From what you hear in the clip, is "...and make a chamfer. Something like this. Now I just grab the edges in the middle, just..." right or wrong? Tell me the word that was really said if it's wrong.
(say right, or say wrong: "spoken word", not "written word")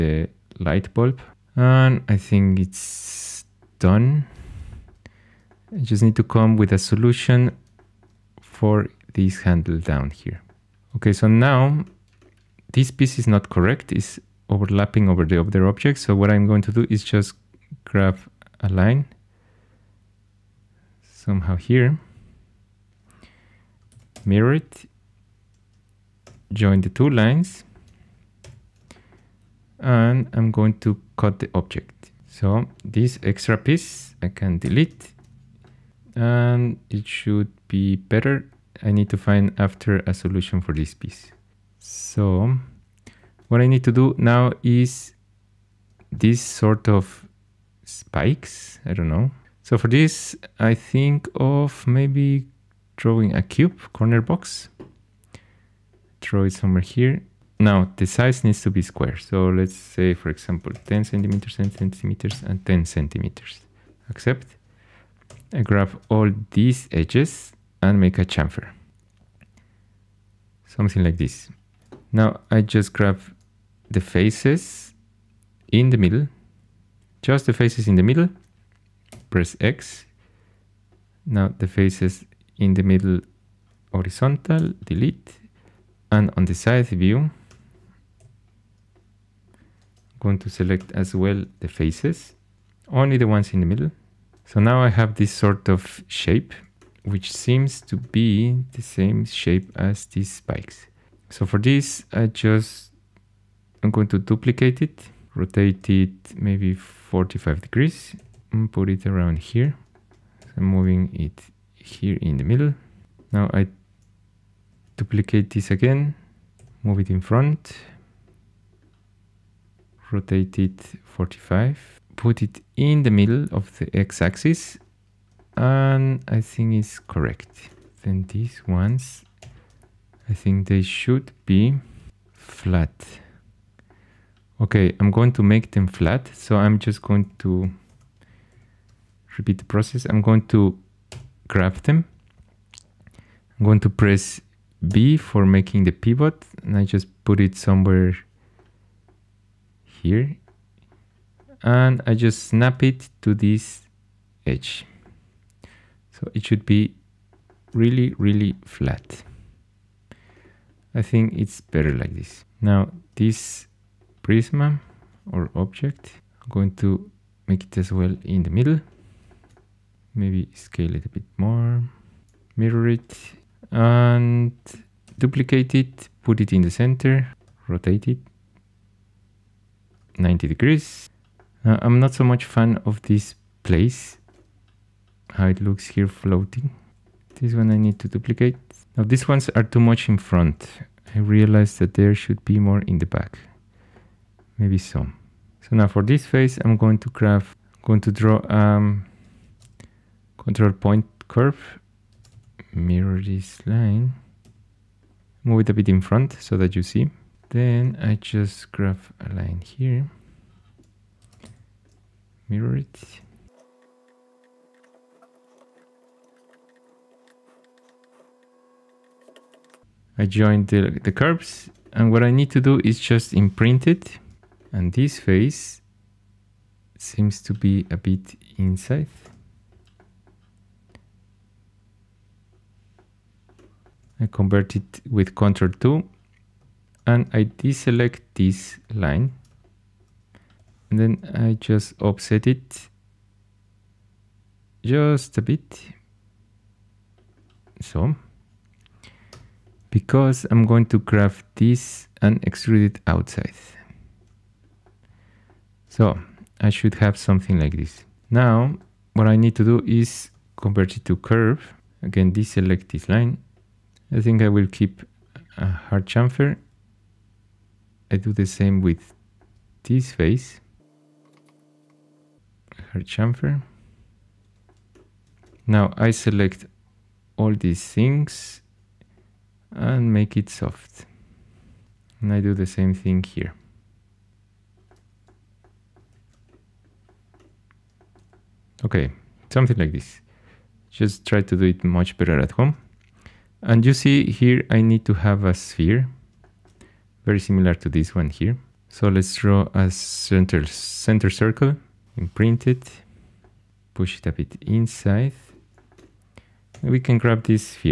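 wrong: "faces", not "edges".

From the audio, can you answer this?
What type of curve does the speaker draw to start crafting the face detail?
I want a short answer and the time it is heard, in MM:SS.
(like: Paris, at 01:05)
control point curve, at 03:20.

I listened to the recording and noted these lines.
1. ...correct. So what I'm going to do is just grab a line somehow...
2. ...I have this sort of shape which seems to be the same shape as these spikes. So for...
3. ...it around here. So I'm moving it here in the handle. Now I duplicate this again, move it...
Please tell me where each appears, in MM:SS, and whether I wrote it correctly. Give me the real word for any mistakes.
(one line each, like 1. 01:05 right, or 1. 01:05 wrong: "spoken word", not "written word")
1. 00:15 wrong: "object", not "correct"
2. 01:34 right
3. 01:48 wrong: "middle", not "handle".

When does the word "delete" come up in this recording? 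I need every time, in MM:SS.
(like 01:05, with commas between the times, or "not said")
00:34, 01:24.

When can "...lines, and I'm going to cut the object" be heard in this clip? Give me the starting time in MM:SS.
00:27.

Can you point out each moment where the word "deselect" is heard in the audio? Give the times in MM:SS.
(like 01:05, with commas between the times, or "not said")
03:57, 04:22.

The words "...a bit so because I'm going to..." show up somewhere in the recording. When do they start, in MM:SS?
04:05.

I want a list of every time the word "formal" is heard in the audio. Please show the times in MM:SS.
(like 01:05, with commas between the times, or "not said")
not said.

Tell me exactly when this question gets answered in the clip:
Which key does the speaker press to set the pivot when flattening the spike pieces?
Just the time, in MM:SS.
02:23.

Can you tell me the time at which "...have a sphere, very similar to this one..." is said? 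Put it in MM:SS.
04:55.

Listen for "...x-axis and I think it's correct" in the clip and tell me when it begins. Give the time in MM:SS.
02:03.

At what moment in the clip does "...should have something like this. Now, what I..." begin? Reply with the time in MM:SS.
04:16.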